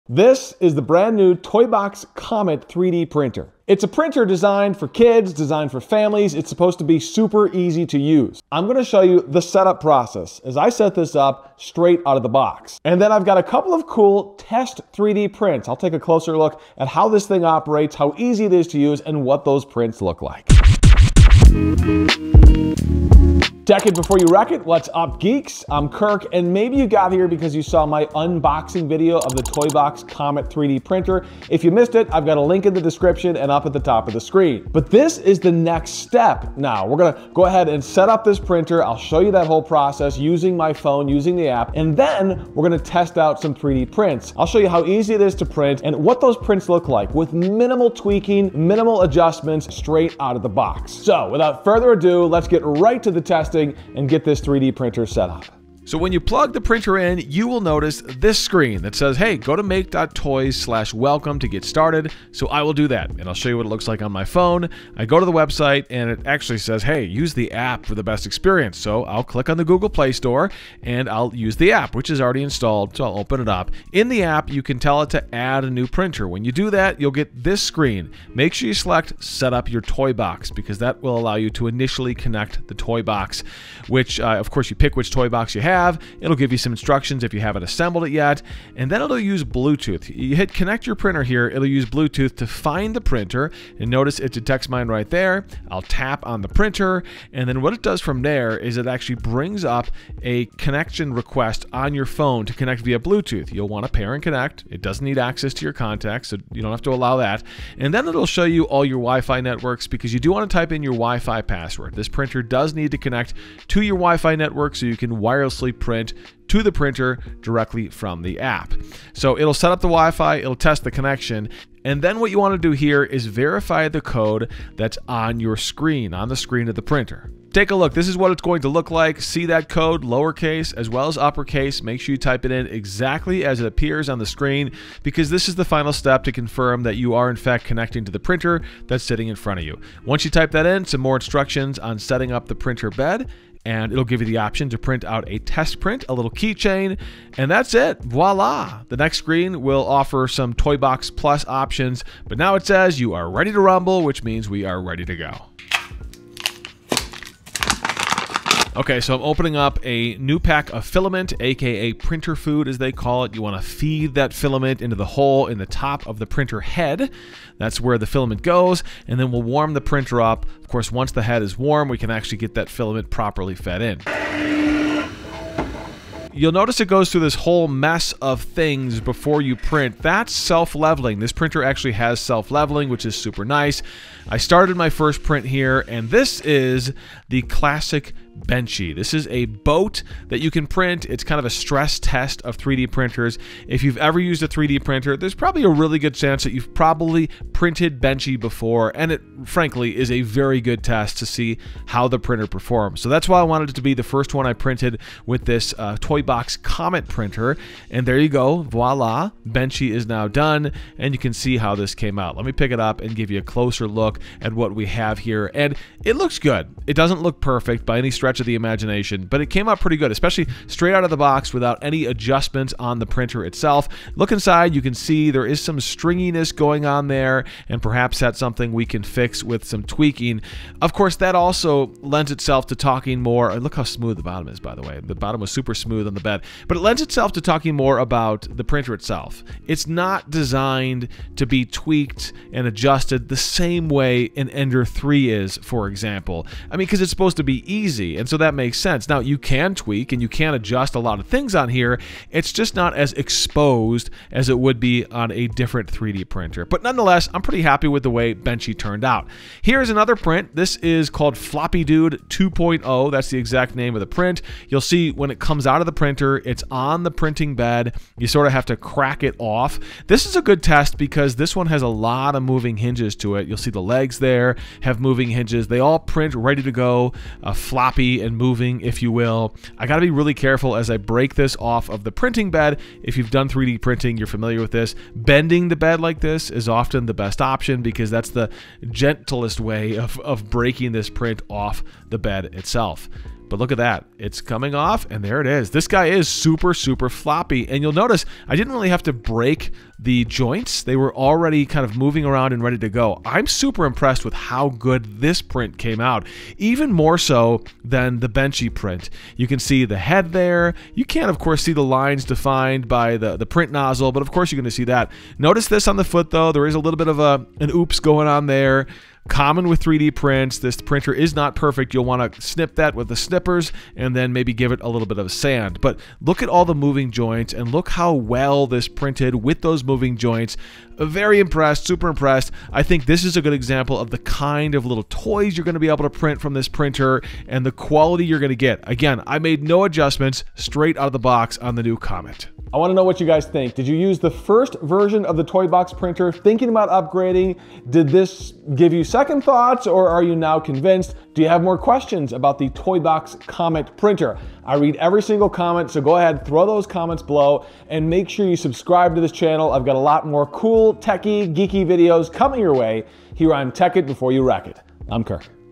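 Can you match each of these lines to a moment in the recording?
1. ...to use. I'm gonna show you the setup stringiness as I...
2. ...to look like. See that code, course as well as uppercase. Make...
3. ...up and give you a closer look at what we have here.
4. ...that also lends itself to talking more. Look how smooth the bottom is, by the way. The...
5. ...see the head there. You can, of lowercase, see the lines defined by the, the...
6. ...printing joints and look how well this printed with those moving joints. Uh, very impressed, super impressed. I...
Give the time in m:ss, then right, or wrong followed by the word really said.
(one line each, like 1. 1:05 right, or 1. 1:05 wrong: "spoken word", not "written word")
1. 0:07 wrong: "process", not "stringiness"
2. 2:08 wrong: "lowercase", not "course"
3. 3:32 right
4. 3:51 right
5. 5:09 wrong: "course", not "lowercase"
6. 5:26 wrong: "moving", not "printing".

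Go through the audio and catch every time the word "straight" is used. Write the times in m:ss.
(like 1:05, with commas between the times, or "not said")
0:11, 0:49, 3:40, 5:40.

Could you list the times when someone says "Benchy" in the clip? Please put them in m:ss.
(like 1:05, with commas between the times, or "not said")
3:08, 3:18, 3:29, 4:18, 5:08.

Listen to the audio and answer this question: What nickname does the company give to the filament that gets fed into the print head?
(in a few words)
Printer food.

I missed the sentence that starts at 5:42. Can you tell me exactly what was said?
I wanna know what you guys think.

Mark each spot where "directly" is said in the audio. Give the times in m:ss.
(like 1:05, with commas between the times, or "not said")
1:57.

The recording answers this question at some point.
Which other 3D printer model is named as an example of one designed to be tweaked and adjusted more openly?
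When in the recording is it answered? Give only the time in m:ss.
4:04.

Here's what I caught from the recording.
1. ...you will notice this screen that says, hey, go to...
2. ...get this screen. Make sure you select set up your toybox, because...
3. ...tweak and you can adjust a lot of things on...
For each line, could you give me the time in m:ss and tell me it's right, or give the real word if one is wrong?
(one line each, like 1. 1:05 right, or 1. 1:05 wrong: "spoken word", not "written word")
1. 0:57 right
2. 1:17 right
3. 4:09 right.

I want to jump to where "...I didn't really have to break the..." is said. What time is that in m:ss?
4:58.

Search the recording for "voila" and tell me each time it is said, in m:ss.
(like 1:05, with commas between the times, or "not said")
2:28, 3:28.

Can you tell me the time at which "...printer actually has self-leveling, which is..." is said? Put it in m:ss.
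3:01.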